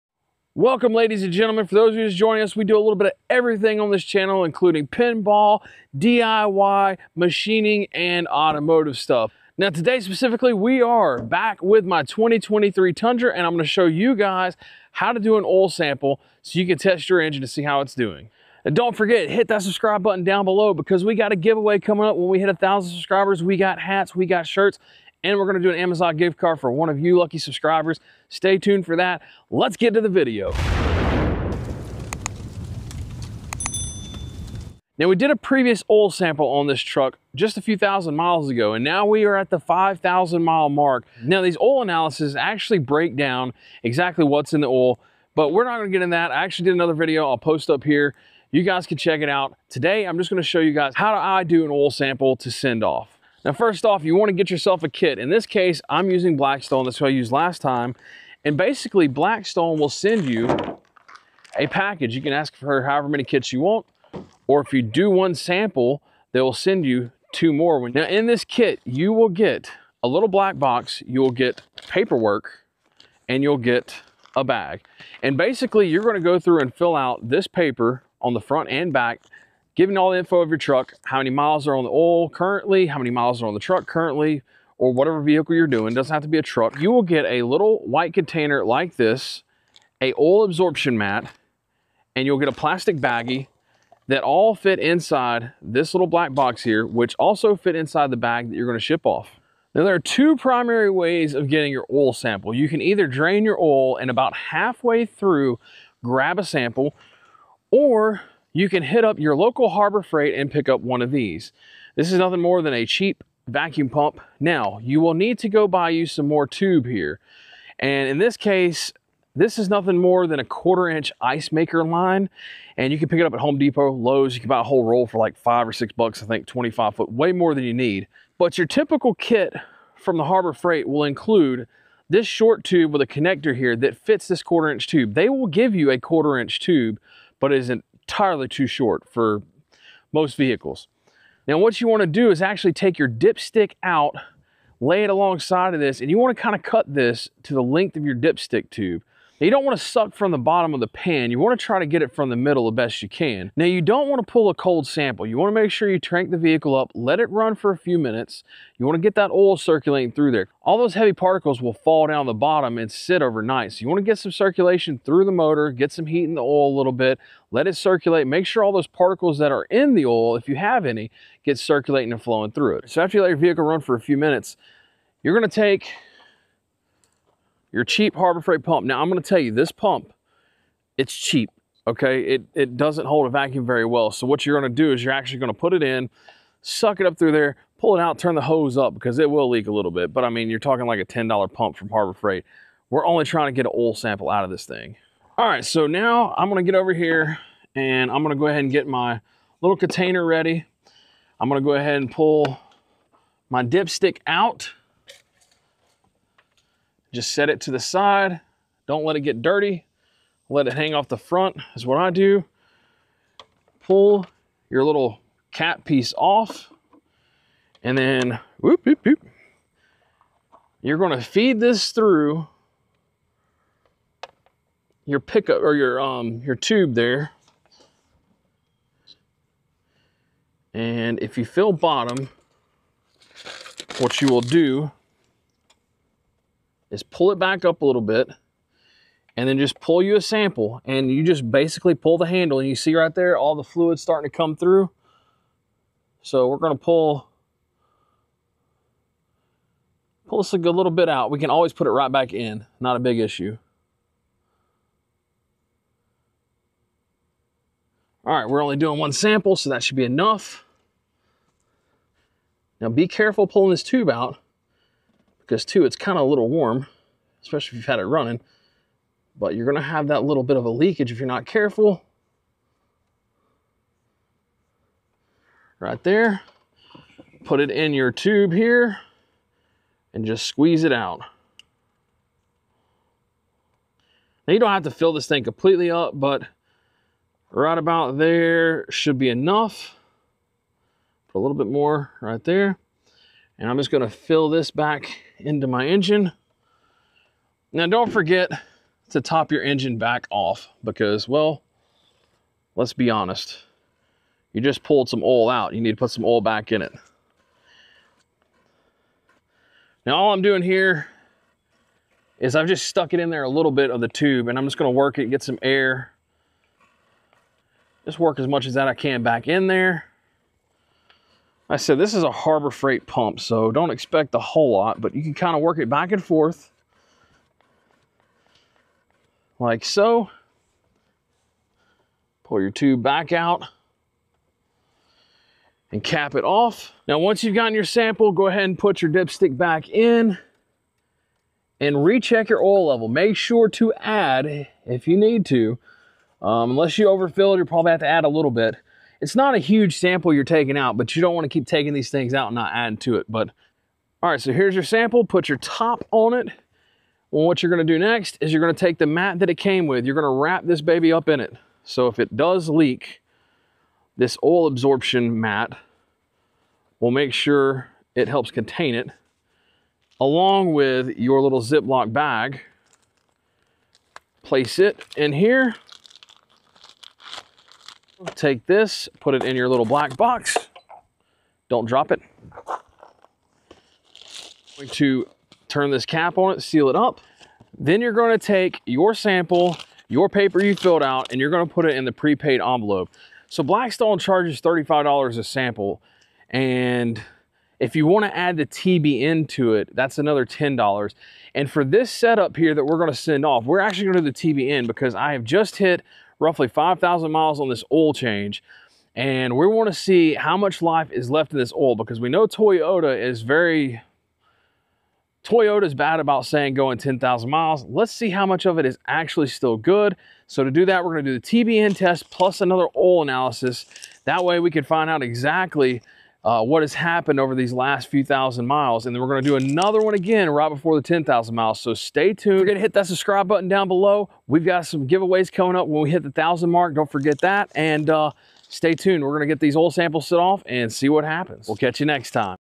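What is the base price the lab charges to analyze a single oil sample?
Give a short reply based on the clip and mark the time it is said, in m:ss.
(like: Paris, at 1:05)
$35, at 6:34.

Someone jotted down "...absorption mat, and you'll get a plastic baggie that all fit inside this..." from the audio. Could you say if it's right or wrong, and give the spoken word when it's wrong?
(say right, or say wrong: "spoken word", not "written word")
right.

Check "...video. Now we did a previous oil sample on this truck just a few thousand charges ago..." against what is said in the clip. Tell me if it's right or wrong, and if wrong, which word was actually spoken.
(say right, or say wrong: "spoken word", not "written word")
wrong: "miles", not "charges".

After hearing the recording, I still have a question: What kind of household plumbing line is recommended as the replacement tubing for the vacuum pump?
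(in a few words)
ice maker line.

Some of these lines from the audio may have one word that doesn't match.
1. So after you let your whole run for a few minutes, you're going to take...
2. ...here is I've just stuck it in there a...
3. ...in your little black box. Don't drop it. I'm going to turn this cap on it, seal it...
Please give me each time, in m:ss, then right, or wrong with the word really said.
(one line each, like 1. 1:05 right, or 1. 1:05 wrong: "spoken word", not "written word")
1. 2:52 wrong: "vehicle", not "whole"
2. 5:10 right
3. 6:19 right.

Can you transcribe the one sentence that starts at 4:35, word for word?
Right there, put it in your tube here and just squeeze it out.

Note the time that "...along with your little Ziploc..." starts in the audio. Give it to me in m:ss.
6:10.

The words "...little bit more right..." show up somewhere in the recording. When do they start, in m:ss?
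4:51.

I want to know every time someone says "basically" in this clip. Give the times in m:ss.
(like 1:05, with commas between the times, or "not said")
0:58, 1:15, 4:01.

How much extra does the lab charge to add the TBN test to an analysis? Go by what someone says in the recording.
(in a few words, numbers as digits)
$10.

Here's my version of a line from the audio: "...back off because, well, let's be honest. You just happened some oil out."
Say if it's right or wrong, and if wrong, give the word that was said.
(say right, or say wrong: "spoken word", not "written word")
wrong: "pulled", not "happened".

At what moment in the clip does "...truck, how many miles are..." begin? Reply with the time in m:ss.
1:20.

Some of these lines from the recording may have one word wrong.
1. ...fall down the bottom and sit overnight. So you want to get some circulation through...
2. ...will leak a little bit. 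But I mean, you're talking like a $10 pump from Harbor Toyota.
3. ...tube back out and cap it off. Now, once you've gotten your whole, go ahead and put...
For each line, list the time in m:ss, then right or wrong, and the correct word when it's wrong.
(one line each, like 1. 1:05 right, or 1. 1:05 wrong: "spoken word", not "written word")
1. 2:41 right
2. 3:09 wrong: "Freight", not "Toyota"
3. 5:32 wrong: "sample", not "whole".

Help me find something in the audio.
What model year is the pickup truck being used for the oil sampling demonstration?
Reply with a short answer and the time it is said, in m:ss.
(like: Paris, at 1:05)
2023, at 0:12.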